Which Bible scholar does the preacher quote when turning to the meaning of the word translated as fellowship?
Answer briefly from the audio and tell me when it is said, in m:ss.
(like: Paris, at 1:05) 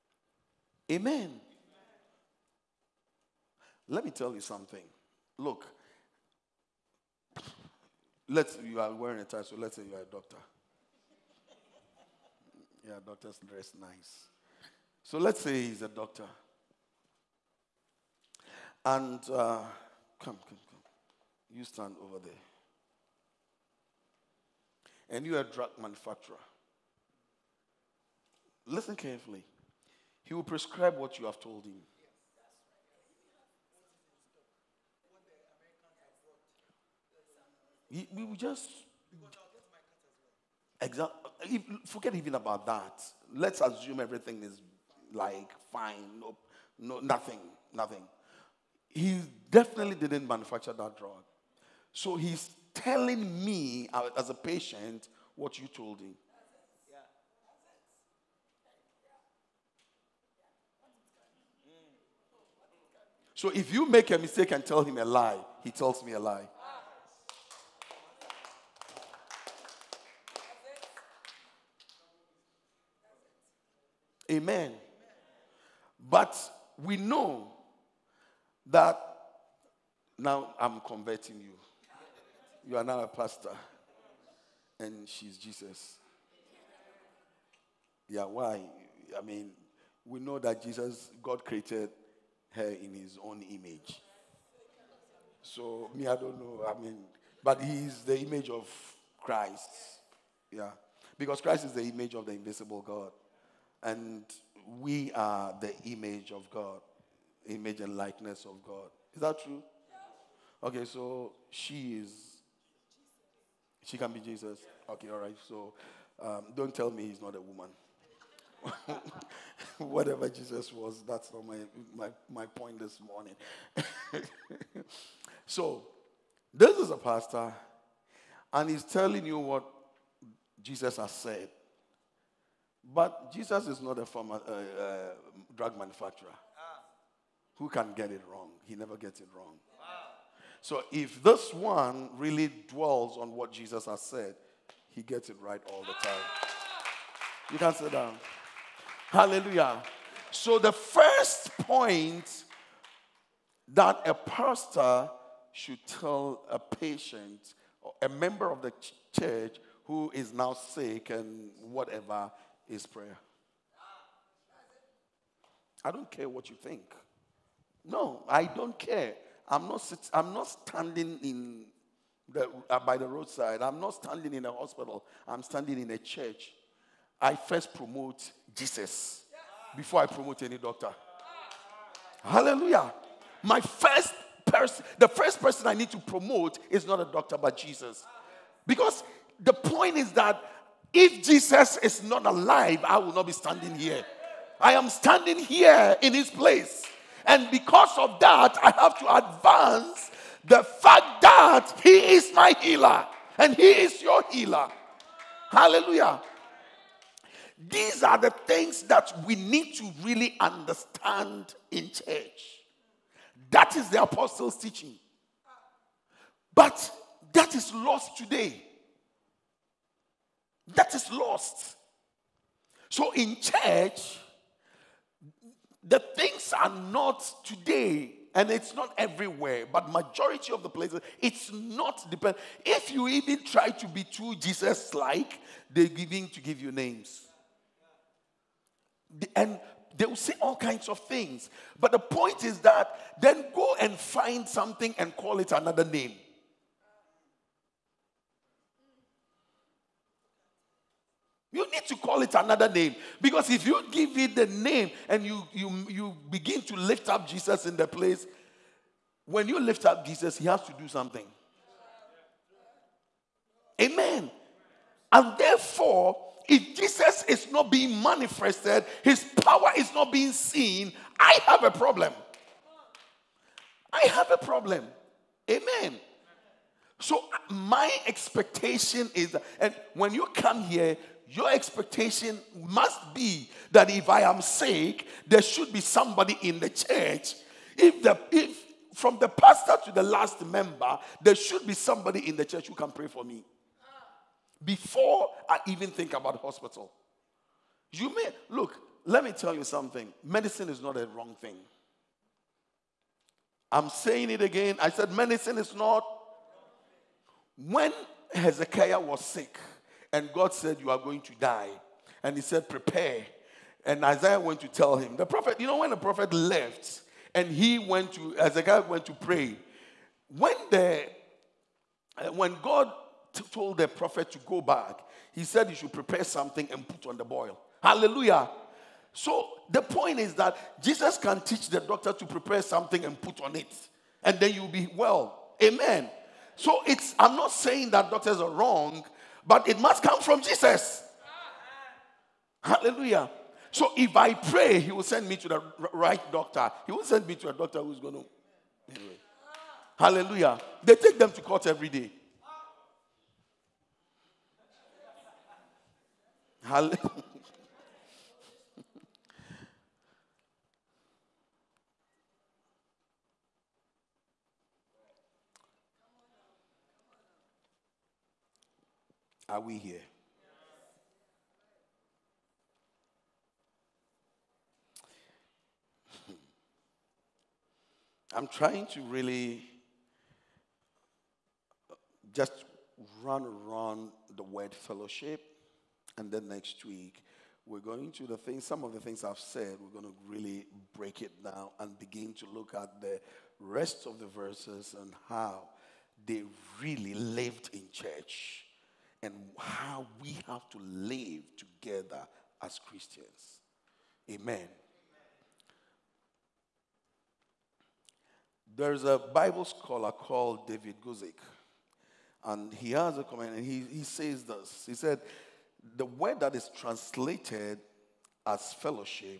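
David Guzik, at 6:50.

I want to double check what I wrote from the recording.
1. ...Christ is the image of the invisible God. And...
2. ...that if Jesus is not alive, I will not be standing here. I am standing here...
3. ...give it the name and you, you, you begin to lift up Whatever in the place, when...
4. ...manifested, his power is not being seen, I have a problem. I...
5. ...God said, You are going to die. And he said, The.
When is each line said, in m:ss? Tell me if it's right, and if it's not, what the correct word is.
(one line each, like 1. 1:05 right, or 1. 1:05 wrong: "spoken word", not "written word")
1. 1:41 right
2. 3:10 right
3. 4:13 wrong: "Jesus", not "Whatever"
4. 4:28 right
5. 5:10 wrong: "Prepare", not "The".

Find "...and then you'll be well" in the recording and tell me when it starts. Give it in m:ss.
5:34.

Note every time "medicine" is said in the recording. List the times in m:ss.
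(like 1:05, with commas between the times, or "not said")
5:00, 5:05.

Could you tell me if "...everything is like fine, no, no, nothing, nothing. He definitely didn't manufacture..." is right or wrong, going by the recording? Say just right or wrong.
right.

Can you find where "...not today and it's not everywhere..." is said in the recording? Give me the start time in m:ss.
3:46.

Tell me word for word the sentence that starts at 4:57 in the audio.
You may look, let me tell you something.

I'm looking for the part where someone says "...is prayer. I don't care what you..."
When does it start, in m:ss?
2:42.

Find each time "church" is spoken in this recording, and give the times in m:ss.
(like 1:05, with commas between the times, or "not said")
2:39, 2:55, 3:31, 3:43, 4:46, 4:52, 6:37.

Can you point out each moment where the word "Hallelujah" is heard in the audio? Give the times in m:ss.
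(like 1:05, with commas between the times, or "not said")
2:29, 3:02, 3:25, 5:27, 5:42, 5:49, 5:56.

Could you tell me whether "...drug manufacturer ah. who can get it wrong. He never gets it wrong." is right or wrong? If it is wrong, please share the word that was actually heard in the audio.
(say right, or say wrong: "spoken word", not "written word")
right.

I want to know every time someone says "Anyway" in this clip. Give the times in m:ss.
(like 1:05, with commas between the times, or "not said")
5:48.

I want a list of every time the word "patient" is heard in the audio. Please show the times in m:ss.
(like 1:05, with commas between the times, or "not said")
0:54, 2:36.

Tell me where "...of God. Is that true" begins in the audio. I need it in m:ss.
1:48.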